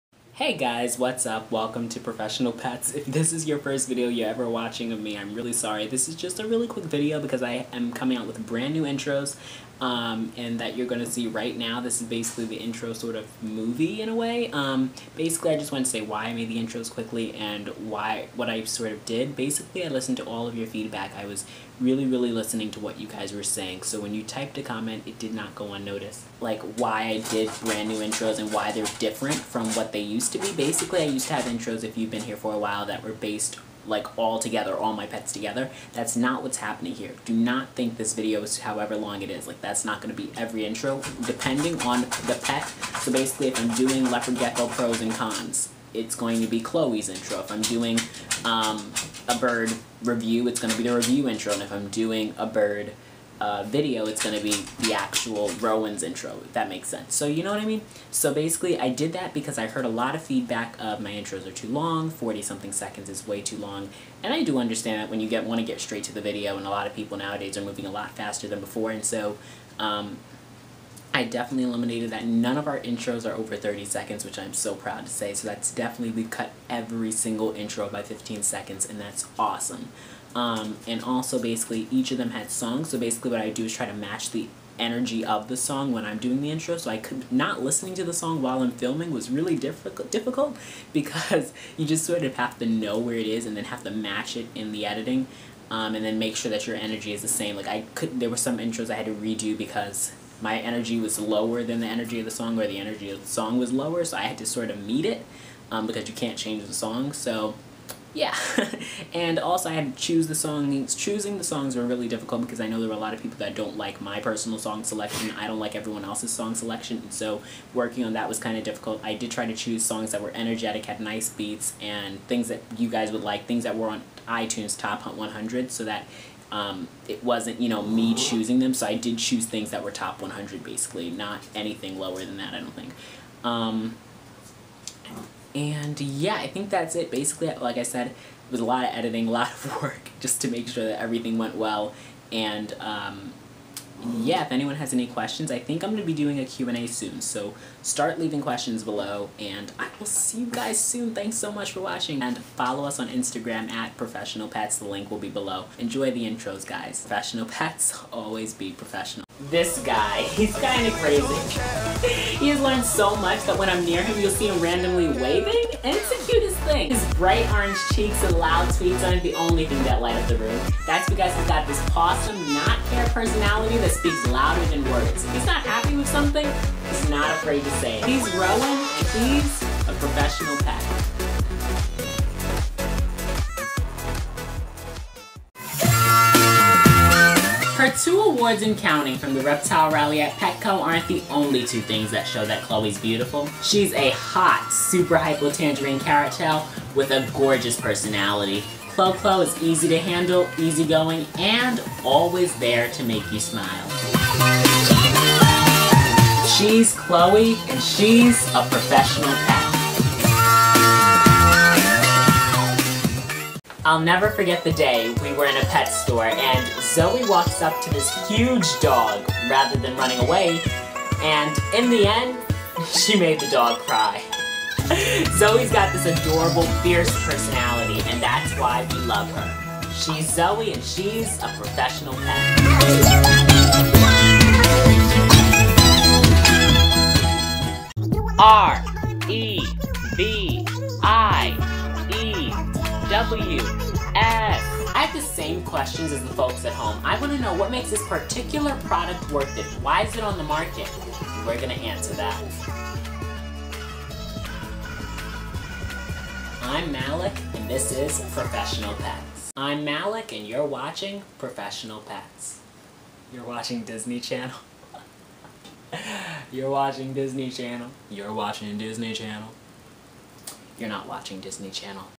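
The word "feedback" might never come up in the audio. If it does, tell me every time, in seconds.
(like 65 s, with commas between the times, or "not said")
20 s, 60 s.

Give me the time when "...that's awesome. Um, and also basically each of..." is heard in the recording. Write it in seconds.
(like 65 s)
79 s.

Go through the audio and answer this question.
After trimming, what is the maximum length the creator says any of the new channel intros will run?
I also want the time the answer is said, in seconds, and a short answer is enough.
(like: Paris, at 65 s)
30 seconds, at 73 s.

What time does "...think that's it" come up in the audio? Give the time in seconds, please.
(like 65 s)
136 s.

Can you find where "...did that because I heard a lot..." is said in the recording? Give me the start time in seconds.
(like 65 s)
58 s.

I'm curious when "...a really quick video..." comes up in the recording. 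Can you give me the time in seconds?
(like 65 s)
6 s.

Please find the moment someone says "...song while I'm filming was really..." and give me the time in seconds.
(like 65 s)
88 s.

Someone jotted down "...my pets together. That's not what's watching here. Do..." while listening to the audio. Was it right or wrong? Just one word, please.
wrong.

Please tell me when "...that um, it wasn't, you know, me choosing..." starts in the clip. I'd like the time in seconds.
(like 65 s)
125 s.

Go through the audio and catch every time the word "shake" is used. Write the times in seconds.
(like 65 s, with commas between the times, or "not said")
not said.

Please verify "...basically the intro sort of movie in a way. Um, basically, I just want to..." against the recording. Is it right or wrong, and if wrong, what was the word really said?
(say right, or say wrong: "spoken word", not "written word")
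right.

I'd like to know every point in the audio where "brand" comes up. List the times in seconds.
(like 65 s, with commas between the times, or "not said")
8 s, 27 s.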